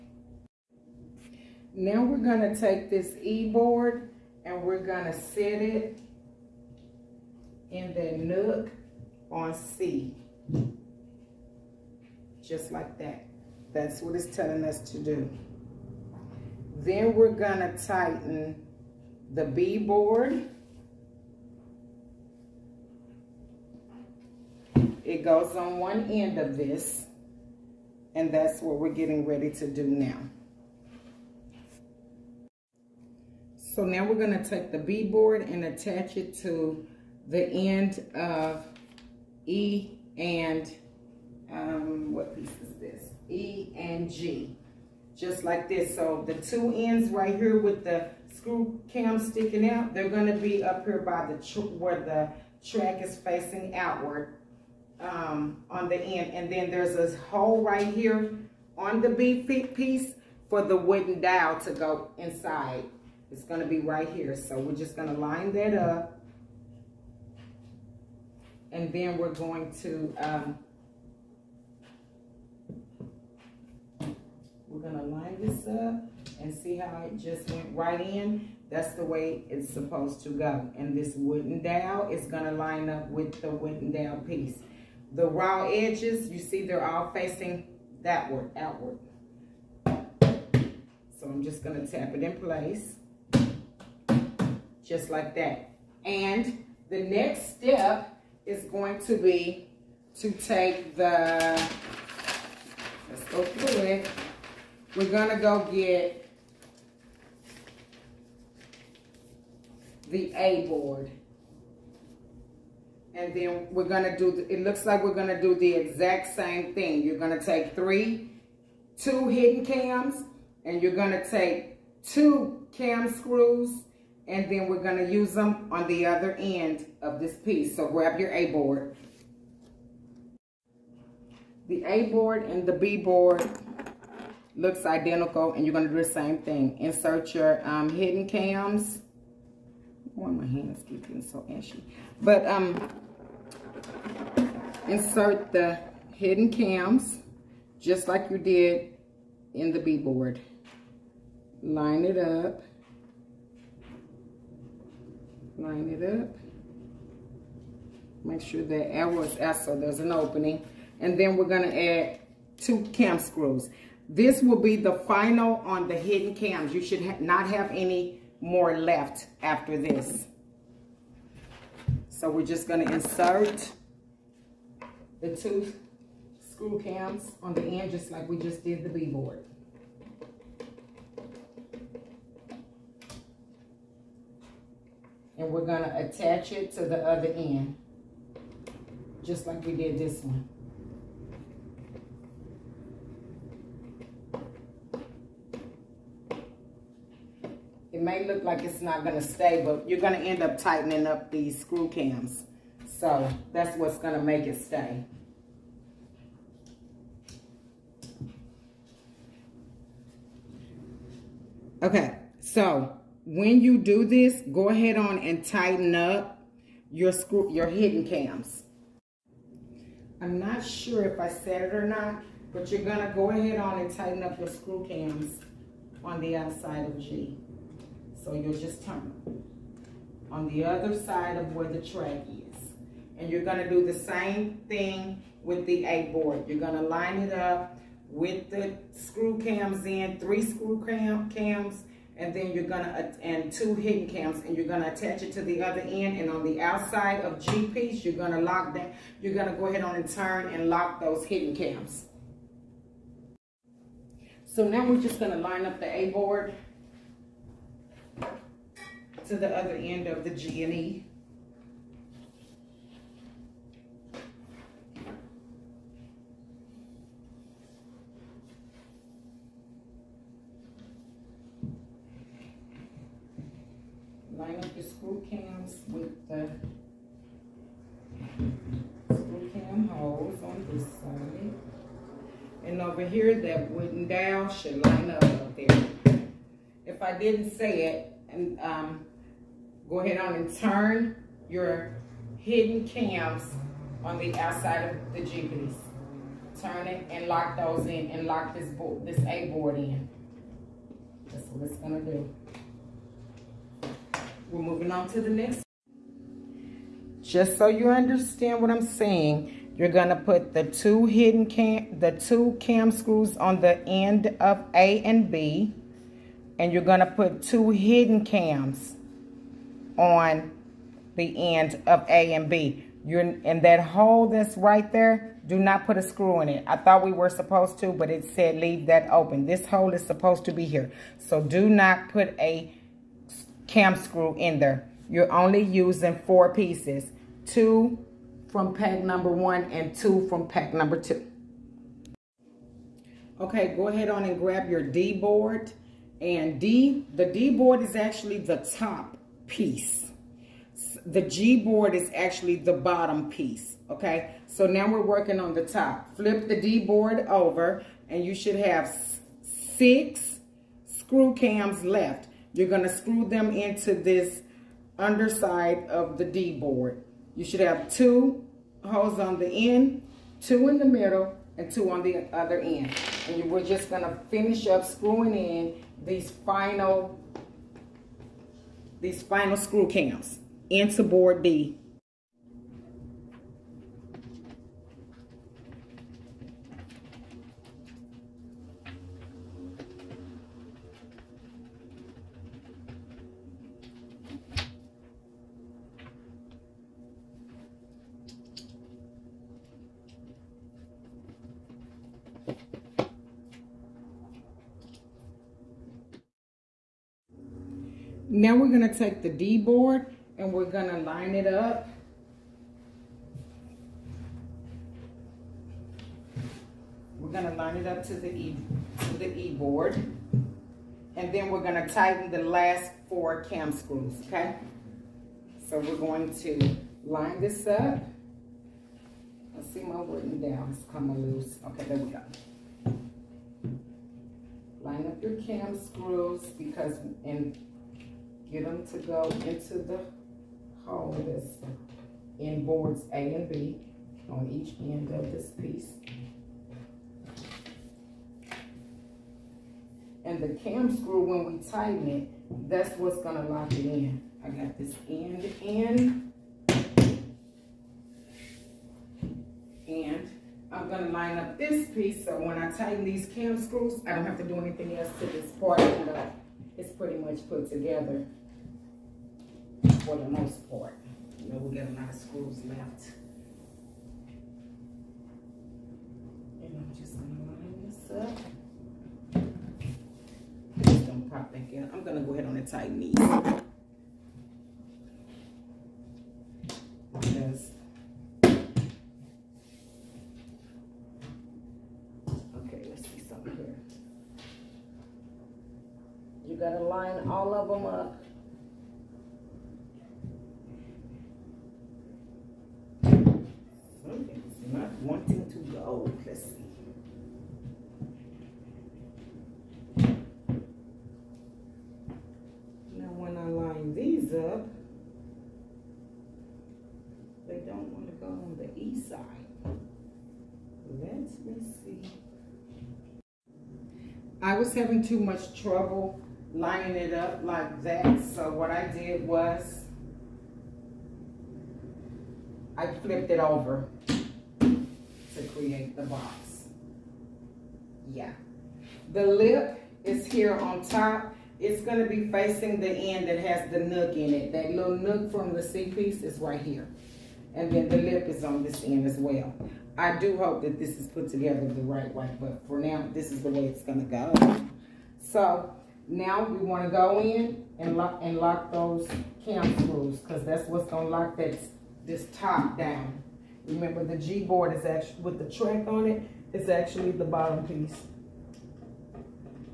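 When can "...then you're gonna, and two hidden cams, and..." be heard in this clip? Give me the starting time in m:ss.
4:02.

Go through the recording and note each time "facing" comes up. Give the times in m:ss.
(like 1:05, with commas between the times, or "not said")
0:53, 1:27, 9:02.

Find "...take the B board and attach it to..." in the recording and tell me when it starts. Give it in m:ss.
0:34.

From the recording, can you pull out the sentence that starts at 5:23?
You're in that hole that's right there, do not put a screw in it.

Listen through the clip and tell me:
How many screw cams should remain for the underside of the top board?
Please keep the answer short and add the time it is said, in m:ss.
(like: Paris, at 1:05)
6, at 5:59.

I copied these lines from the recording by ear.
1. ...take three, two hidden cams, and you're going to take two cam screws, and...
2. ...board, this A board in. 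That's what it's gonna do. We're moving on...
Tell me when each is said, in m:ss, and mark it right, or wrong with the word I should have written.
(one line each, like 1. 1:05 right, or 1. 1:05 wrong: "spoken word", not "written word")
1. 1:57 right
2. 4:58 right.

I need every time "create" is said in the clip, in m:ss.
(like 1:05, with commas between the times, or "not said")
8:55.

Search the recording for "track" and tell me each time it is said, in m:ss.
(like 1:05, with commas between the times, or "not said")
0:52, 3:51, 9:25.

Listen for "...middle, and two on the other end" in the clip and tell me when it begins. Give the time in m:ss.
6:10.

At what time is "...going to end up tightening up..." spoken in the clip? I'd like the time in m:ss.
3:19.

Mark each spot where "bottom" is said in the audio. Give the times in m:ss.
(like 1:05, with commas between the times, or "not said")
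5:52, 9:27.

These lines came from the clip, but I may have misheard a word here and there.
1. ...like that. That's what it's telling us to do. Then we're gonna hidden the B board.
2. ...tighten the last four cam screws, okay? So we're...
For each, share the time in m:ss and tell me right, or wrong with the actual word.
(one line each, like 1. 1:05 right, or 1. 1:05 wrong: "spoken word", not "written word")
1. 0:12 wrong: "tighten", not "hidden"
2. 7:01 right.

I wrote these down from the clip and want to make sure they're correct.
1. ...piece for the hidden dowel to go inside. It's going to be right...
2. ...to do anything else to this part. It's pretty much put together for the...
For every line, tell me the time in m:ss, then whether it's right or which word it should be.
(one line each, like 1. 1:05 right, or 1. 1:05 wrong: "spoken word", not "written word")
1. 0:59 wrong: "wooden", not "hidden"
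2. 7:44 right.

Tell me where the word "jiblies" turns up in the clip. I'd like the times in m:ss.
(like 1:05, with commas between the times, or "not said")
4:55.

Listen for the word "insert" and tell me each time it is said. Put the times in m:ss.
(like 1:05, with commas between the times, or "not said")
2:16, 2:24, 2:52.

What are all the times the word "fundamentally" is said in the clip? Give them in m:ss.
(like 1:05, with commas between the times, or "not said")
not said.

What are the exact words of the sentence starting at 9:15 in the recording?
So now we wanna go in and lock, and lock those cam screws because that's what's gonna lock that, this top down.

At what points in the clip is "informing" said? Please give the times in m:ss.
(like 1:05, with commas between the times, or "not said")
not said.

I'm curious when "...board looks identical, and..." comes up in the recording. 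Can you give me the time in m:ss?
2:12.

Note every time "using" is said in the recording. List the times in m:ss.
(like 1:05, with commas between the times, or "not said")
5:35.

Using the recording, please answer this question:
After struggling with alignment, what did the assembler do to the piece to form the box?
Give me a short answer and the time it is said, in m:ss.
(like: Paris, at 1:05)
flipped it over, at 8:53.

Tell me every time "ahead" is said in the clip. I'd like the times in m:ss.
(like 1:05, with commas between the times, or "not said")
3:34, 3:43, 4:09, 4:49, 5:43, 8:02.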